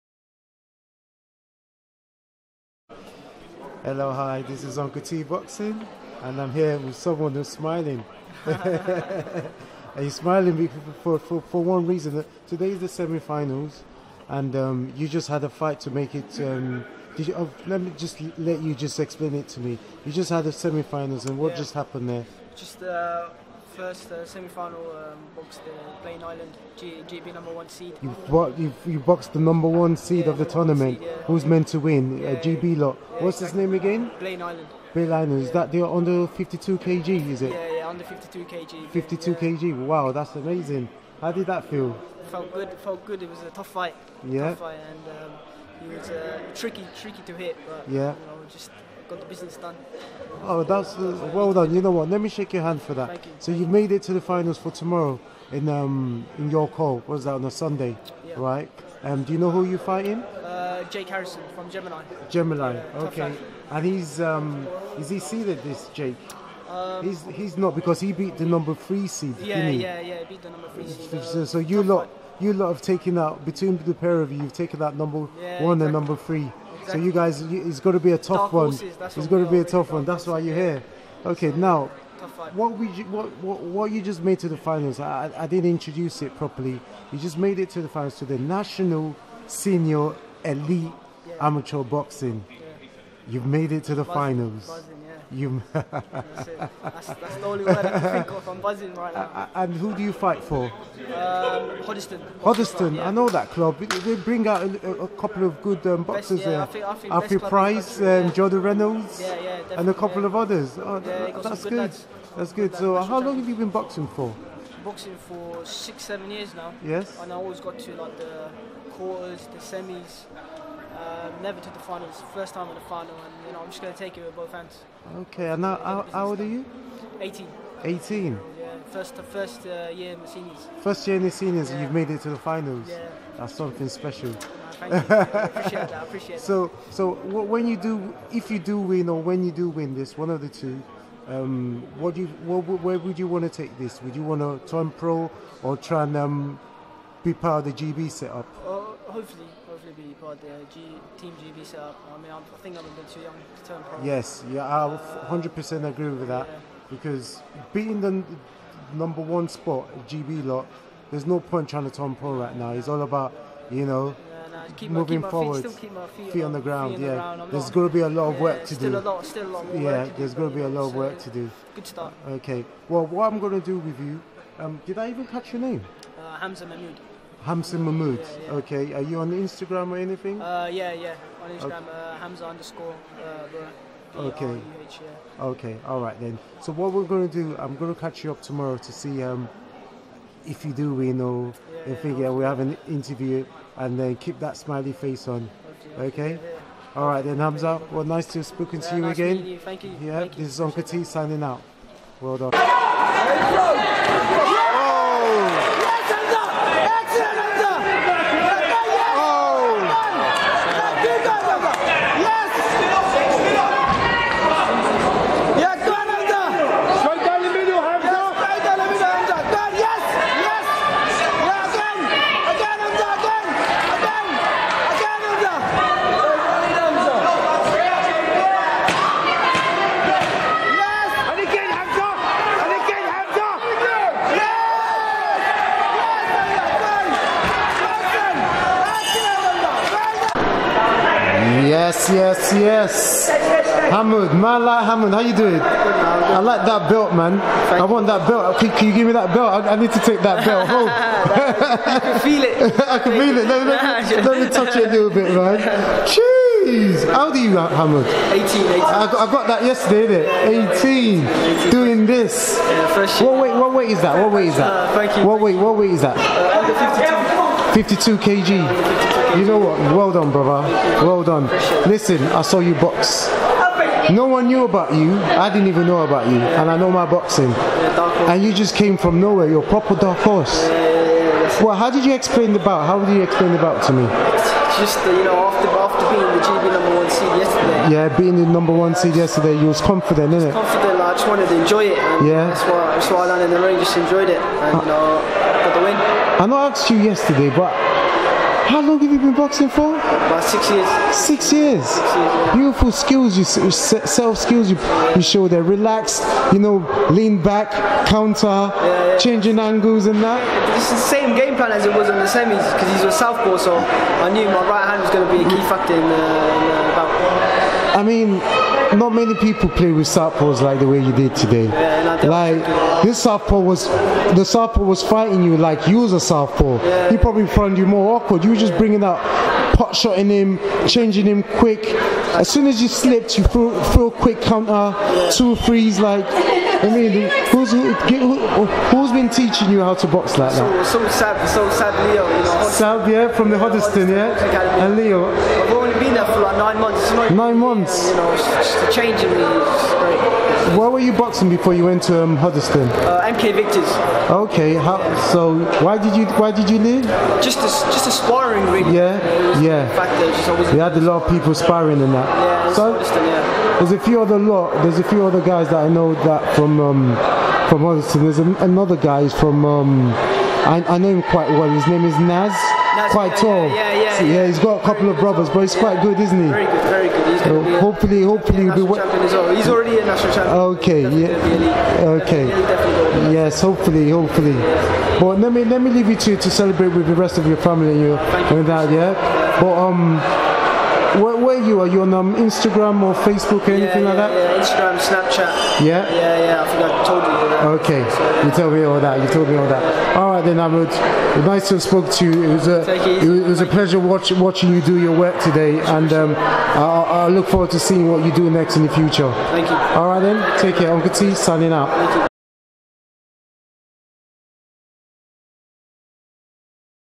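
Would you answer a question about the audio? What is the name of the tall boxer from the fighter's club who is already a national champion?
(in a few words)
Naz.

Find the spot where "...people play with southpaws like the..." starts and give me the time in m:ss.
5:19.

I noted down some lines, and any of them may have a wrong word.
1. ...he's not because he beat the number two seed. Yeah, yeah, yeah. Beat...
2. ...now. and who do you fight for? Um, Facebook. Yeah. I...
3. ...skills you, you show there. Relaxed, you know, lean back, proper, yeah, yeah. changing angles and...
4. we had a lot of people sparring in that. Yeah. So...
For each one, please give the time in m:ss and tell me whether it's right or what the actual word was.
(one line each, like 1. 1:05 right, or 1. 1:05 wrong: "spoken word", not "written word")
1. 1:07 wrong: "three", not "two"
2. 1:39 wrong: "Hoddesdon", not "Facebook"
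3. 5:04 wrong: "counter", not "proper"
4. 6:00 right.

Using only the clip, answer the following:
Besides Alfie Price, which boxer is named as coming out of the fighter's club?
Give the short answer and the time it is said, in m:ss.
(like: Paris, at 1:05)
Jordan Reynolds, at 1:48.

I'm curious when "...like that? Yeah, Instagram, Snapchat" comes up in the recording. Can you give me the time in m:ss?
6:34.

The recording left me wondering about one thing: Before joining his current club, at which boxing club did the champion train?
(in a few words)
MK Victors.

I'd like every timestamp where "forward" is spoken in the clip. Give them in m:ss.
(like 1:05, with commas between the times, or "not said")
2:45, 6:47.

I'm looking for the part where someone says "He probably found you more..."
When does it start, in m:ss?
5:27.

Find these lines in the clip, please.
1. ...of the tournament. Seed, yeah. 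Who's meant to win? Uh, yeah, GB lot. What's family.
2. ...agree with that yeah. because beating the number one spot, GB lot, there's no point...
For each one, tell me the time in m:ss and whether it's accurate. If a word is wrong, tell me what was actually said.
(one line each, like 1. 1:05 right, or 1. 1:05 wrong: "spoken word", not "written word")
1. 0:30 wrong: "exactly", not "family"
2. 2:35 right.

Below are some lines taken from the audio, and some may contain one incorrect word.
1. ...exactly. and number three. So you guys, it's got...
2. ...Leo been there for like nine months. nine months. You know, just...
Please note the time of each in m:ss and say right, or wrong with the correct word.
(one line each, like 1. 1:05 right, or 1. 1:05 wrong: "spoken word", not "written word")
1. 1:15 right
2. 5:44 right.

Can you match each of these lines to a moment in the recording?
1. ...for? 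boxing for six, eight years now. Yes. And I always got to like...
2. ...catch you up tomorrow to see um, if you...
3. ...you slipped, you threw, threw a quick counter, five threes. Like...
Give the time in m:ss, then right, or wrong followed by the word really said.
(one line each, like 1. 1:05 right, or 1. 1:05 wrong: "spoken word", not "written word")
1. 1:54 wrong: "seven", not "eight"
2. 3:07 right
3. 5:32 wrong: "two", not "five".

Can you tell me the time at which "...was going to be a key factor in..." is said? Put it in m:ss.
5:15.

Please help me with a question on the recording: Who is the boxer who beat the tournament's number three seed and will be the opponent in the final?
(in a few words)
Jake Harrison.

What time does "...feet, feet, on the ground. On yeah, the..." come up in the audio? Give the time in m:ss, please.
2:46.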